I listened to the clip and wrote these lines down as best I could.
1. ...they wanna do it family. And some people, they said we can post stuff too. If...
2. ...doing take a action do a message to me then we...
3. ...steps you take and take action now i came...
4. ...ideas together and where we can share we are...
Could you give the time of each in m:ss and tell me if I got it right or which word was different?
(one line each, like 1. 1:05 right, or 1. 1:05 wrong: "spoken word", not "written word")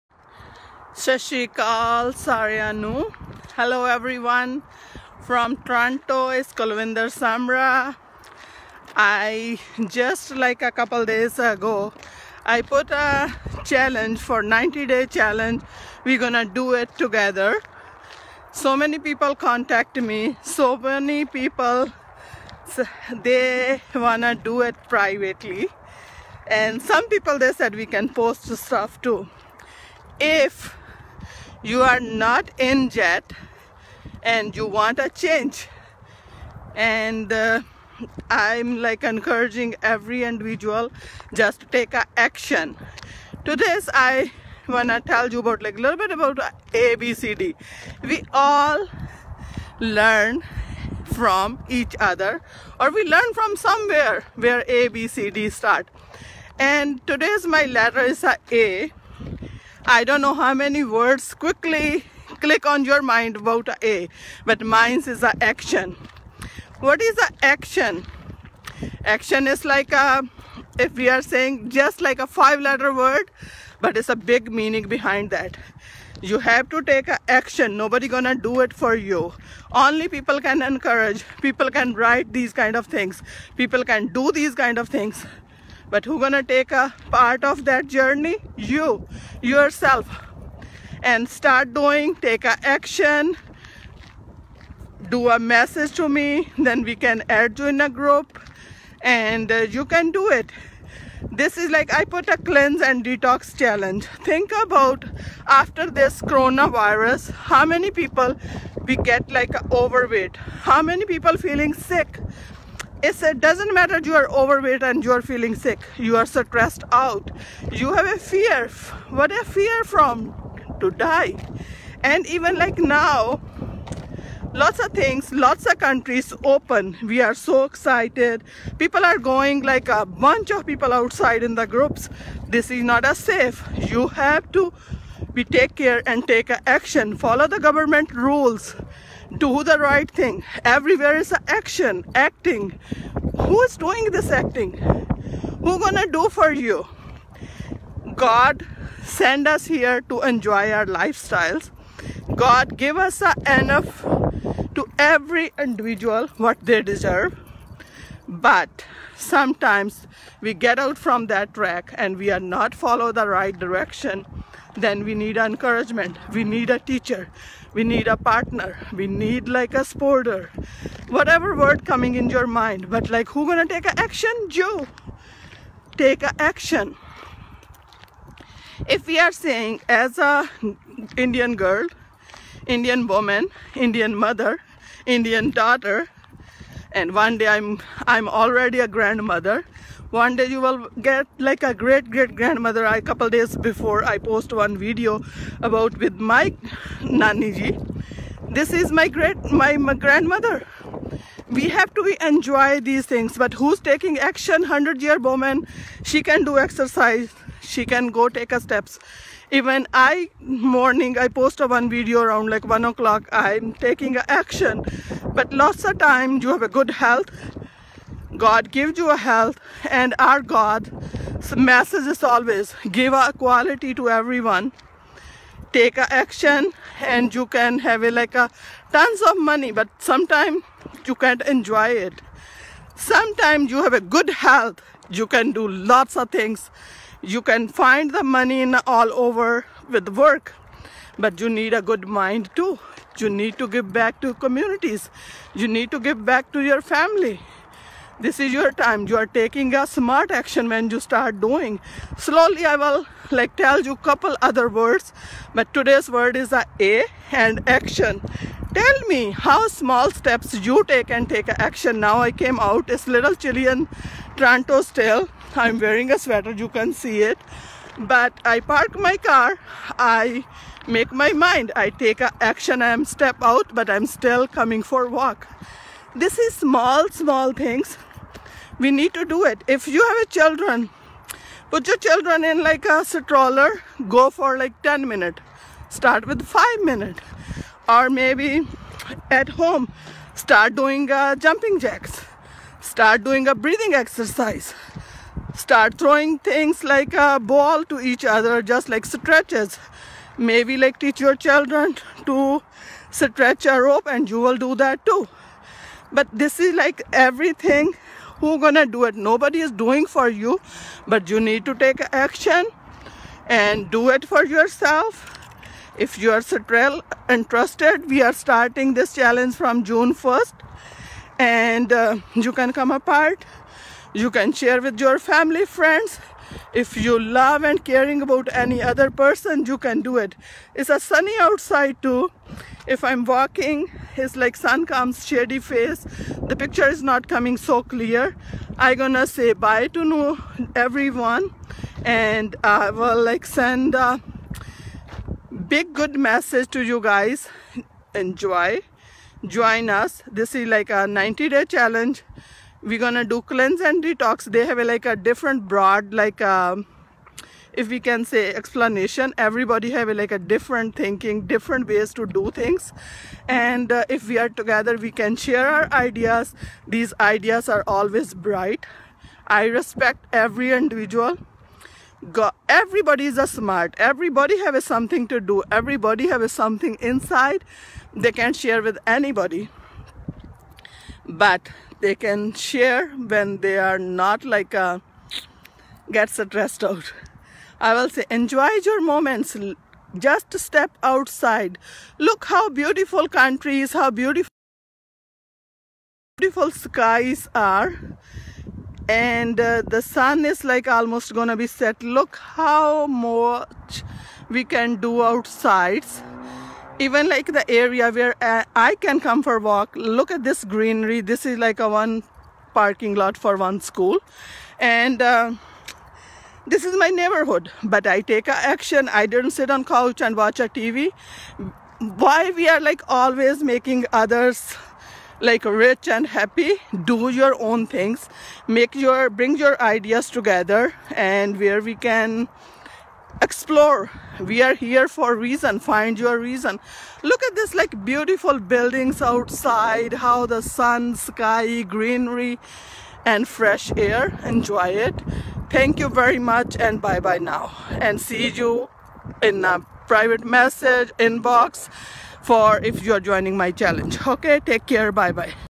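1. 0:23 wrong: "privately", not "family"
2. 1:31 right
3. 4:20 right
4. 7:09 wrong: "explore", not "share".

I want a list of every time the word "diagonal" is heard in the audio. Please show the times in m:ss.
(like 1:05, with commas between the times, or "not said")
not said.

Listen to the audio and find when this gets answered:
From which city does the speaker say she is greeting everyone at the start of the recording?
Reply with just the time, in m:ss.
0:05.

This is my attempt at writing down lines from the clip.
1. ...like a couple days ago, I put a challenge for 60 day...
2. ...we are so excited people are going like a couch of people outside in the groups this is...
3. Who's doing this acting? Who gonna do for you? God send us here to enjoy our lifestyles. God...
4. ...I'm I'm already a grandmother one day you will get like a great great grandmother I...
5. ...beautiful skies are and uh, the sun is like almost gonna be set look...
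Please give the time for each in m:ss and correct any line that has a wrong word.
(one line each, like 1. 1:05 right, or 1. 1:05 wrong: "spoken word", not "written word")
1. 0:10 wrong: "90", not "60"
2. 2:07 wrong: "bunch", not "couch"
3. 2:23 right
4. 3:07 right
5. 6:36 right.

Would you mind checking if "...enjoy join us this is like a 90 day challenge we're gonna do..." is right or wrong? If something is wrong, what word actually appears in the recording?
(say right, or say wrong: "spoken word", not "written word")
right.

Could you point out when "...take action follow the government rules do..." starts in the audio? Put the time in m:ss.
2:16.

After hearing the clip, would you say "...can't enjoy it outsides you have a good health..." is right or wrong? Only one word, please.
wrong.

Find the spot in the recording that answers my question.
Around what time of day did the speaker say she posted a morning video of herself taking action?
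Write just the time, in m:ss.
3:32.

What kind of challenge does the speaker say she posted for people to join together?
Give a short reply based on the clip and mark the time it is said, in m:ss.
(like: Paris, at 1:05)
Cleanse and detox challenge, at 1:42.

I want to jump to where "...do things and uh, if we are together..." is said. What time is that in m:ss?
6:02.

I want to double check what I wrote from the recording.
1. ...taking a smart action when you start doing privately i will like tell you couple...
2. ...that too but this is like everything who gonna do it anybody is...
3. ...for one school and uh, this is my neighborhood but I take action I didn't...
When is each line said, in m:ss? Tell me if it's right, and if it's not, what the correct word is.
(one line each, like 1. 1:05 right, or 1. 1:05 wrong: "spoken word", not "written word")
1. 4:09 wrong: "slowly", not "privately"
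2. 5:04 wrong: "nobody", not "anybody"
3. 6:53 right.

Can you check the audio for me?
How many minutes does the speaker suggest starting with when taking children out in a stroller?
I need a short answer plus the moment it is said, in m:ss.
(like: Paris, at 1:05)
5, at 4:46.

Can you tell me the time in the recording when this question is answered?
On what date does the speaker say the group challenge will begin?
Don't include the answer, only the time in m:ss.
5:19.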